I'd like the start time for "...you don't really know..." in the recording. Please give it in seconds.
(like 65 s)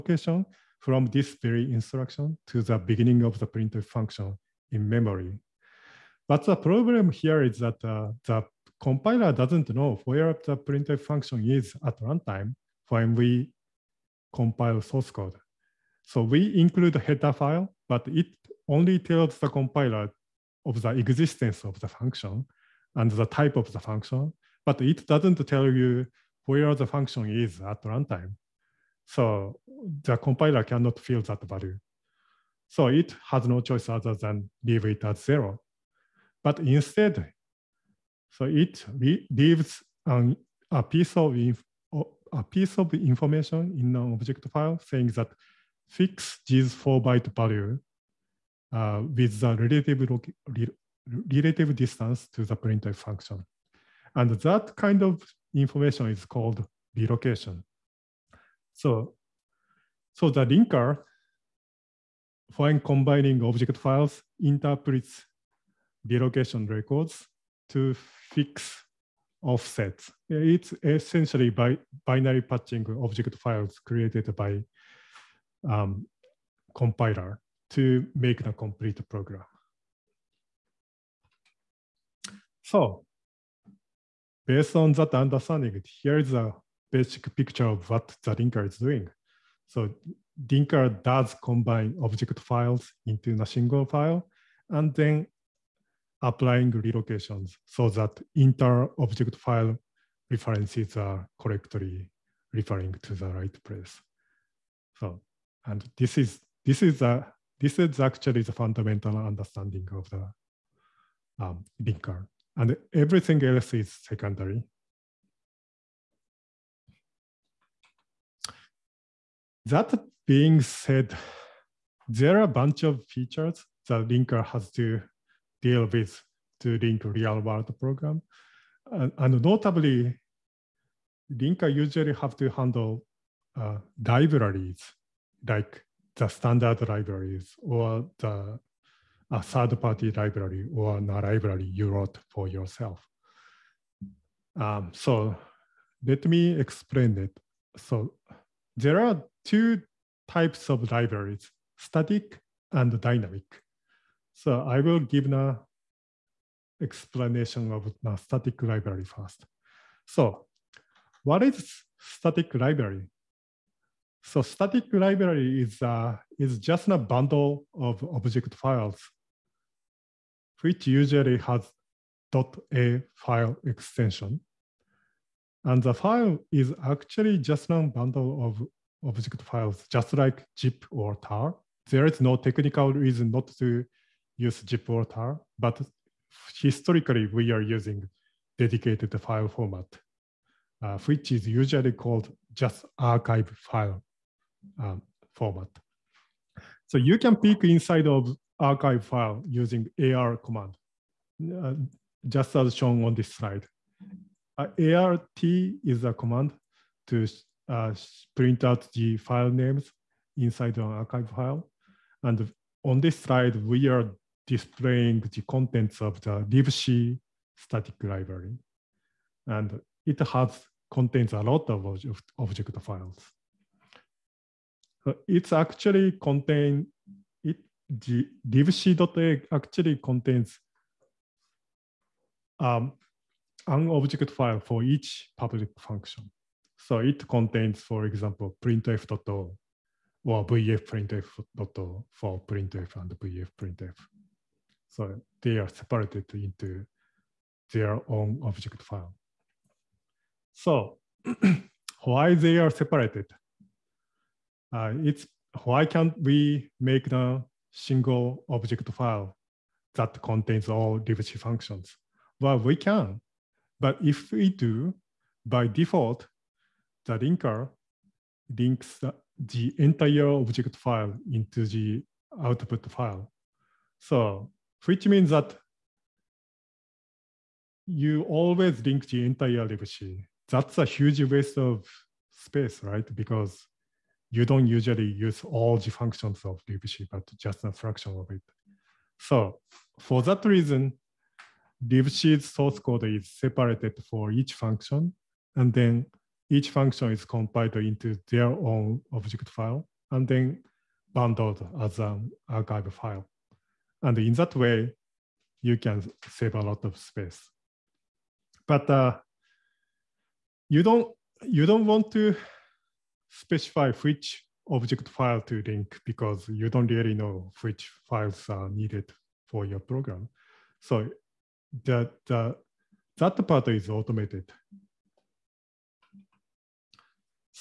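316 s.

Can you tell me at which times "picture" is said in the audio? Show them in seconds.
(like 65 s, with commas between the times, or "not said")
87 s.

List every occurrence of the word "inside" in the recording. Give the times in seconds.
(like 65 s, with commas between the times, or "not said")
197 s, 210 s.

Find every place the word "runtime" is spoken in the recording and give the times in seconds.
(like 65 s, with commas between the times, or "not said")
12 s, 27 s.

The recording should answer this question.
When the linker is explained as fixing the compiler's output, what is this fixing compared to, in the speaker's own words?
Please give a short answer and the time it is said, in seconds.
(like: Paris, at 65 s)
binary patching, at 72 s.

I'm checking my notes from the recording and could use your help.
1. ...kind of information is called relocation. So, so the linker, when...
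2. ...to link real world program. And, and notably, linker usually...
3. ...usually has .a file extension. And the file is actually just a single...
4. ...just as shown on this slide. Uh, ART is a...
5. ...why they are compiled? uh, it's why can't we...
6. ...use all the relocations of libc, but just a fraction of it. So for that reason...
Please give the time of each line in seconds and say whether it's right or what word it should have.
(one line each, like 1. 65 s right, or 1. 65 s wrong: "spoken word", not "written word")
1. 54 s right
2. 126 s right
3. 170 s wrong: "bundle", not "single"
4. 202 s right
5. 252 s wrong: "separated", not "compiled"
6. 285 s wrong: "functions", not "relocations".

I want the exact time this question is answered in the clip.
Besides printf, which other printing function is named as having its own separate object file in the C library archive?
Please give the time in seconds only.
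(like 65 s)
243 s.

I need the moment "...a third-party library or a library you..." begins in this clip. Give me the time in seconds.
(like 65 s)
139 s.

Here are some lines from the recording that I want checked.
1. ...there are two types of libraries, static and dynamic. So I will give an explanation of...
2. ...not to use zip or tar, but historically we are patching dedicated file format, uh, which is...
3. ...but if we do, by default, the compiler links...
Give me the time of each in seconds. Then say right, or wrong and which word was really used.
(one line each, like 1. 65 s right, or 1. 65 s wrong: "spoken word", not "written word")
1. 148 s right
2. 183 s wrong: "using", not "patching"
3. 263 s wrong: "linker", not "compiler".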